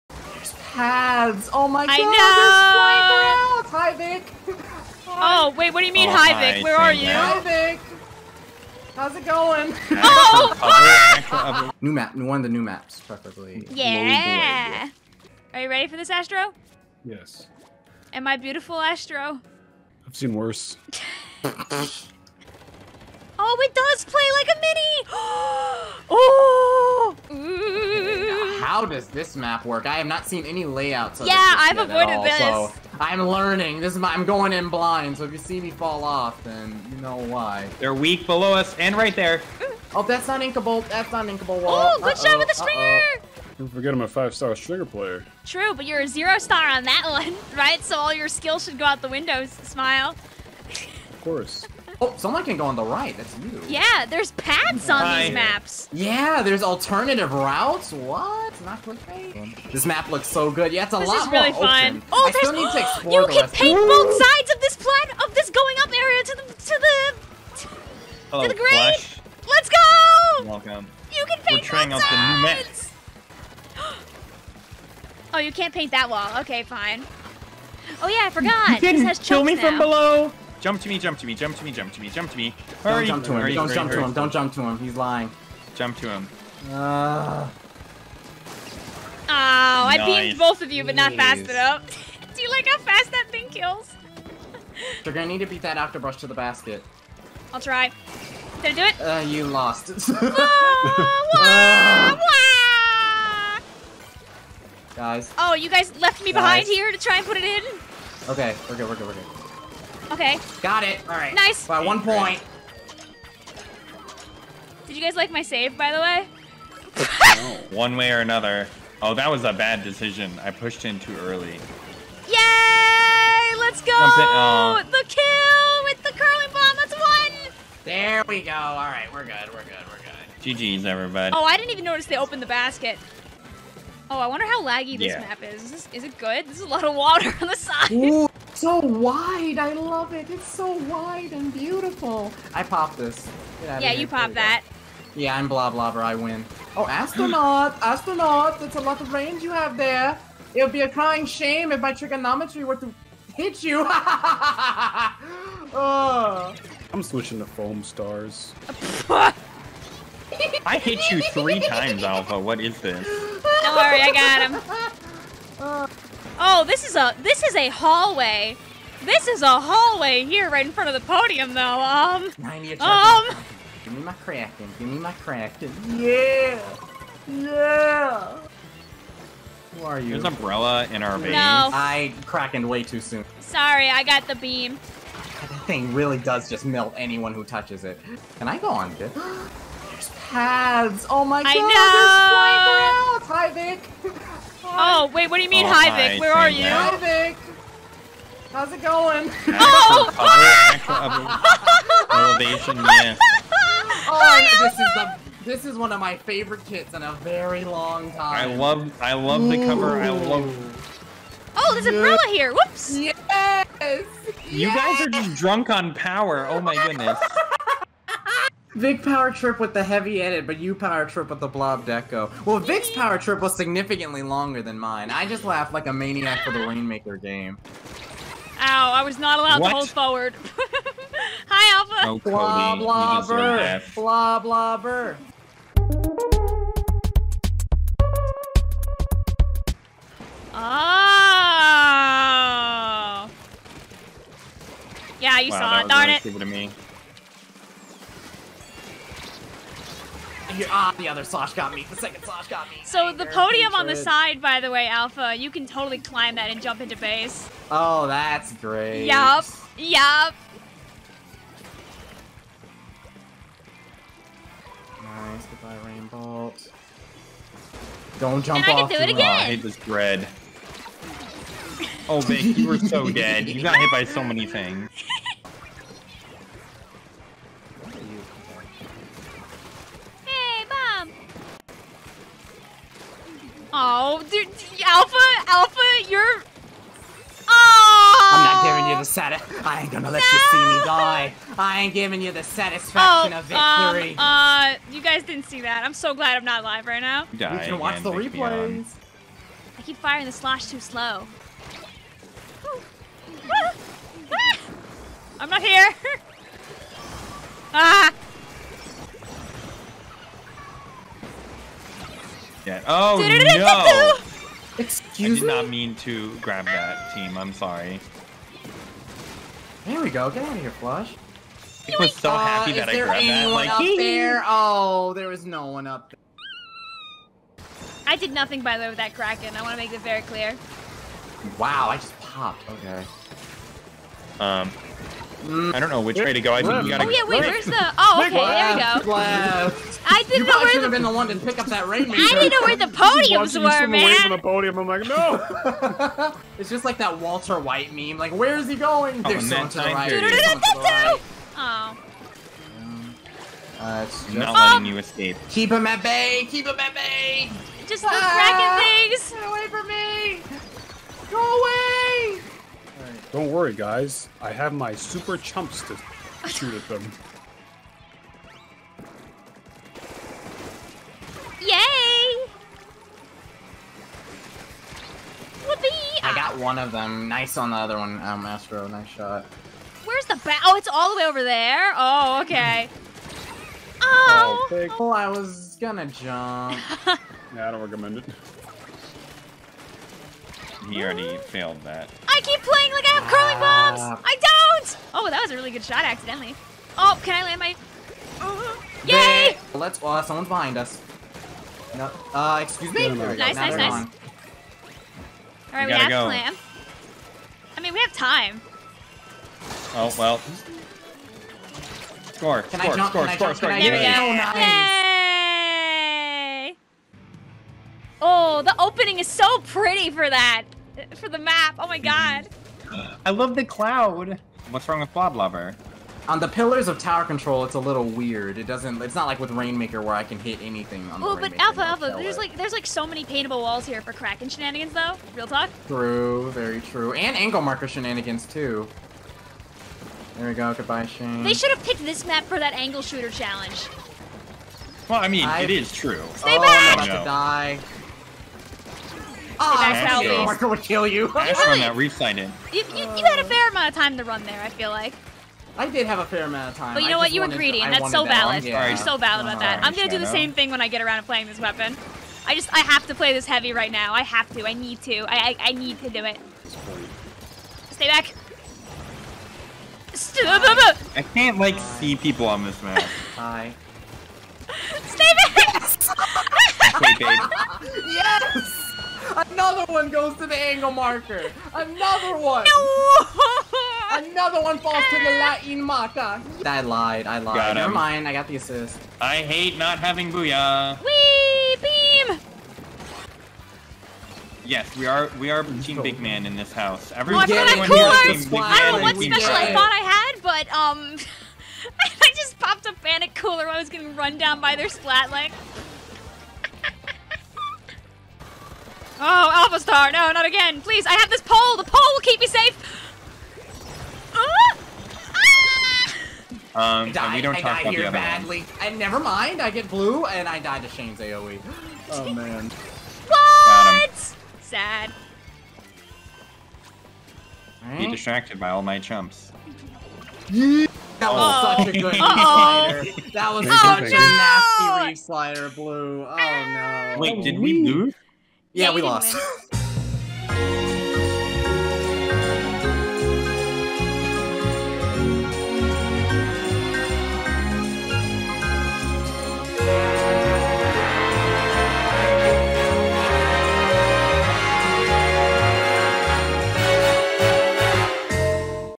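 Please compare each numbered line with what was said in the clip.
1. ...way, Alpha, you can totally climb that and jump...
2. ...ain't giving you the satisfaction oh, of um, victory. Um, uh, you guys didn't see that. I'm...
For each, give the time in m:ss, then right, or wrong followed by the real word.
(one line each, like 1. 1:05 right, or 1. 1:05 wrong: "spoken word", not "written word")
1. 4:14 right
2. 4:51 right.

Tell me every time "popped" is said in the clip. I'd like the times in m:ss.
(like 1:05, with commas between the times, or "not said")
5:32, 8:22.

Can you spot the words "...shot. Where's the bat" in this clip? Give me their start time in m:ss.
6:19.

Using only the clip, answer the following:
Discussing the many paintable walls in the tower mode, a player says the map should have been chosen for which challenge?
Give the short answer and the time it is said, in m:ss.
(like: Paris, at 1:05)
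angle shooter challenge, at 7:22.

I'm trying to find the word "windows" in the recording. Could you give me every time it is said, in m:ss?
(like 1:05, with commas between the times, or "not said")
0:49.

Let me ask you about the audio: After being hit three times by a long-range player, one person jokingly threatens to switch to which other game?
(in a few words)
Foam Stars.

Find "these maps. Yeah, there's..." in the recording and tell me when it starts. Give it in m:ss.
0:55.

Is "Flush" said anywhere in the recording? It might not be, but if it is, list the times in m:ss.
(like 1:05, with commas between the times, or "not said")
5:20.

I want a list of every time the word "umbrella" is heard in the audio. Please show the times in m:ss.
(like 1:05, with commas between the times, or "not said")
3:00, 3:31.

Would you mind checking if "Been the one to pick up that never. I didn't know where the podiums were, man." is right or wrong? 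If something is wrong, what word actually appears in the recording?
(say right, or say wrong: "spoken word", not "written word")
wrong: "rainmaker", not "never".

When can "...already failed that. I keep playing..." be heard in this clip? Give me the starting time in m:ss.
6:31.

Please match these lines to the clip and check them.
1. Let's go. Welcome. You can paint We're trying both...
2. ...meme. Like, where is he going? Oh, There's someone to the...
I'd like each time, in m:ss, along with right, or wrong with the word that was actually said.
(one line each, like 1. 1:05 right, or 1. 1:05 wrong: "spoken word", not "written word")
1. 1:09 right
2. 5:47 right.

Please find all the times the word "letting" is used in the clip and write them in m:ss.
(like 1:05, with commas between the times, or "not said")
5:54.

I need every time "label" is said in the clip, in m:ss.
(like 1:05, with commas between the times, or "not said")
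not said.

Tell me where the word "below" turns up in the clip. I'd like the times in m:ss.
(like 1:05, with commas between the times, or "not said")
0:38, 1:19.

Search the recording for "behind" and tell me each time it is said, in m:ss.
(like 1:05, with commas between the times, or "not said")
1:46, 6:40.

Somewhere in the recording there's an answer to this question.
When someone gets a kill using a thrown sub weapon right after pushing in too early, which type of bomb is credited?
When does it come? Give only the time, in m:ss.
2:06.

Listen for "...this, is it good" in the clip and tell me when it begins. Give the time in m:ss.
2:15.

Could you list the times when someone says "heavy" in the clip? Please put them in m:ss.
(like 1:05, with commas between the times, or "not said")
3:39, 7:43.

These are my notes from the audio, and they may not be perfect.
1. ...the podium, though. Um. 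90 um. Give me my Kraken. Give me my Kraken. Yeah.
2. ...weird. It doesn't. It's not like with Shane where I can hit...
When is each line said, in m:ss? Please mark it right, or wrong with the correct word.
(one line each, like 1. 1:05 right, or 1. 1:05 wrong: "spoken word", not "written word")
1. 2:50 right
2. 7:08 wrong: "Rainmaker", not "Shane".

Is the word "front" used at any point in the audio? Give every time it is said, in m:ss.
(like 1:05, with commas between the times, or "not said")
2:50.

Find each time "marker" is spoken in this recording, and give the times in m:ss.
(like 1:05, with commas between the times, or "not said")
7:17, 8:00, 8:05.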